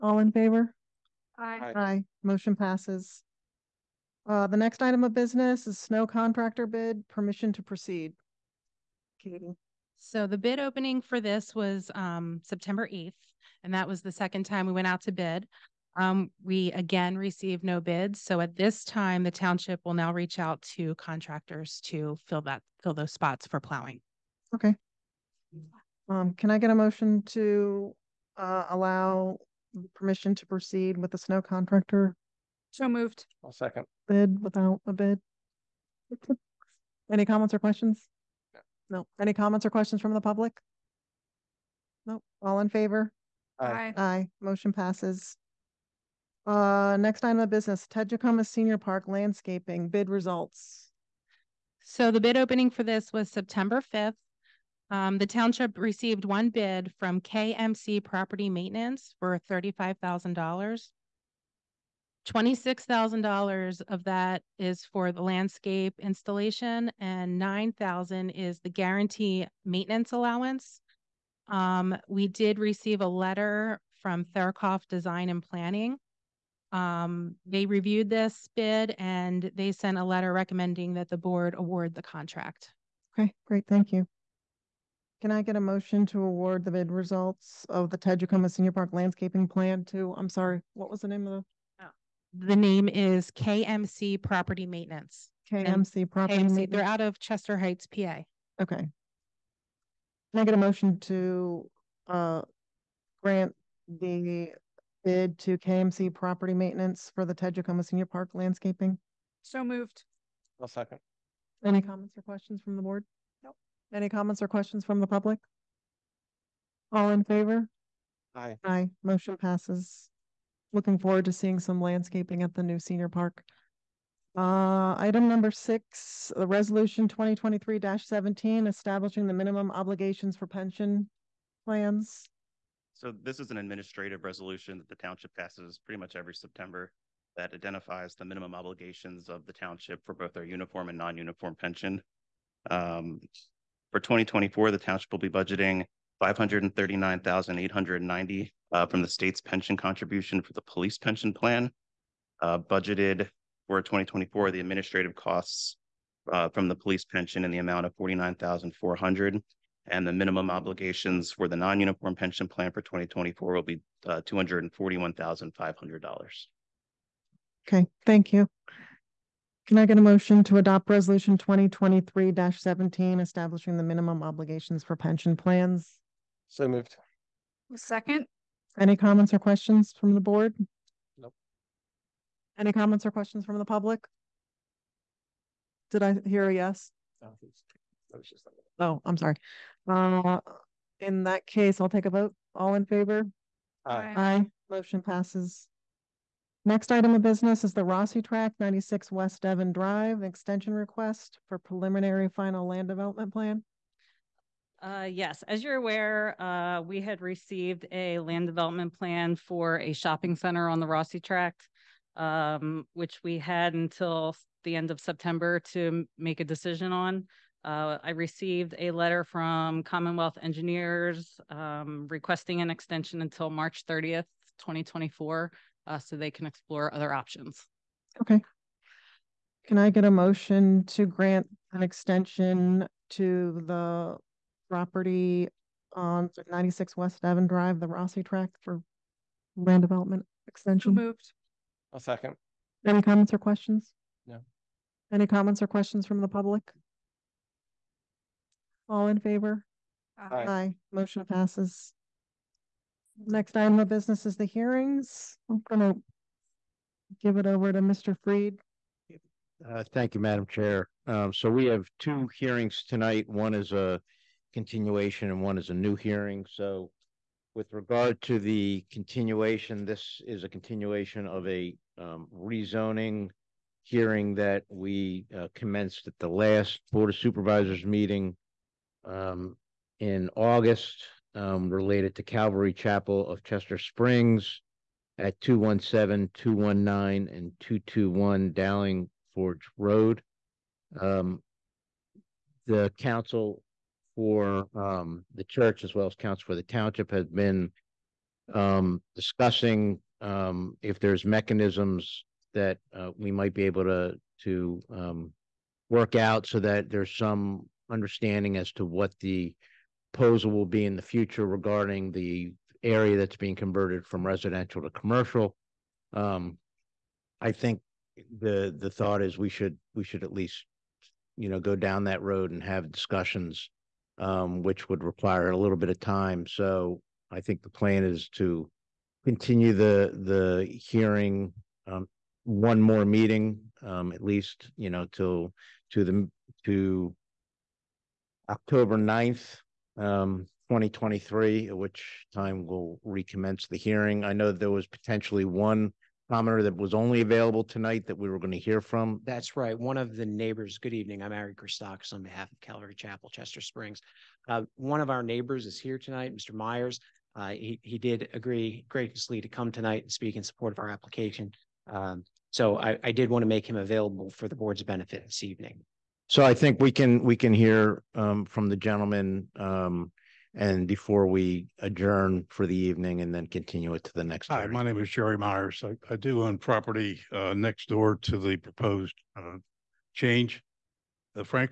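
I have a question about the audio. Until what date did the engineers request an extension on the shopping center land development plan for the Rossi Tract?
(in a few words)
March 30th, 2024.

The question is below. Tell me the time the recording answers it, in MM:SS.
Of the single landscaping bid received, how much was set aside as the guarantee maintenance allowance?
01:07.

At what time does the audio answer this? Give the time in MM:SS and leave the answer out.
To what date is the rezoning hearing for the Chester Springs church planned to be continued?
05:38.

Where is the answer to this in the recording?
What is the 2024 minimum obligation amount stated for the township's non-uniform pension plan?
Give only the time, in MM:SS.
02:44.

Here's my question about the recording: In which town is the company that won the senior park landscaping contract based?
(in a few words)
Chester Heights, PA.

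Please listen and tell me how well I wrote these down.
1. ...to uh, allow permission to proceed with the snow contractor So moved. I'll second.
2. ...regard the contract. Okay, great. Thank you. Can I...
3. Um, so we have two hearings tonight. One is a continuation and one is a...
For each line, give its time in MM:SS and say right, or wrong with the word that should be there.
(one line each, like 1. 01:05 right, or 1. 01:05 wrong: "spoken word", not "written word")
1. 00:27 right
2. 01:21 wrong: "award", not "regard"
3. 04:21 right.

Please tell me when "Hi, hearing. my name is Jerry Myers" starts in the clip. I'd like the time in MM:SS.
06:14.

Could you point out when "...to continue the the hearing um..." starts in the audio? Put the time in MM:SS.
05:28.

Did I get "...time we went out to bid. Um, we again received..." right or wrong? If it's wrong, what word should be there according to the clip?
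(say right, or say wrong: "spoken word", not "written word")
right.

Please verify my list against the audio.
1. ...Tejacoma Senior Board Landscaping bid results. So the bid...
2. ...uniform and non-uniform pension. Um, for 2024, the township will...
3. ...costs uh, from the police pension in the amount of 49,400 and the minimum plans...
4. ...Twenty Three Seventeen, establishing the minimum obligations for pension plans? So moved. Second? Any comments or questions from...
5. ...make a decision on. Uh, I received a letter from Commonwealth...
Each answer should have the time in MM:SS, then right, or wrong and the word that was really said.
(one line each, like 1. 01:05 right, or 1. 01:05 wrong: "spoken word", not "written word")
1. 00:47 wrong: "Park", not "Board"
2. 02:20 right
3. 02:35 wrong: "obligations", not "plans"
4. 02:51 right
5. 03:36 right.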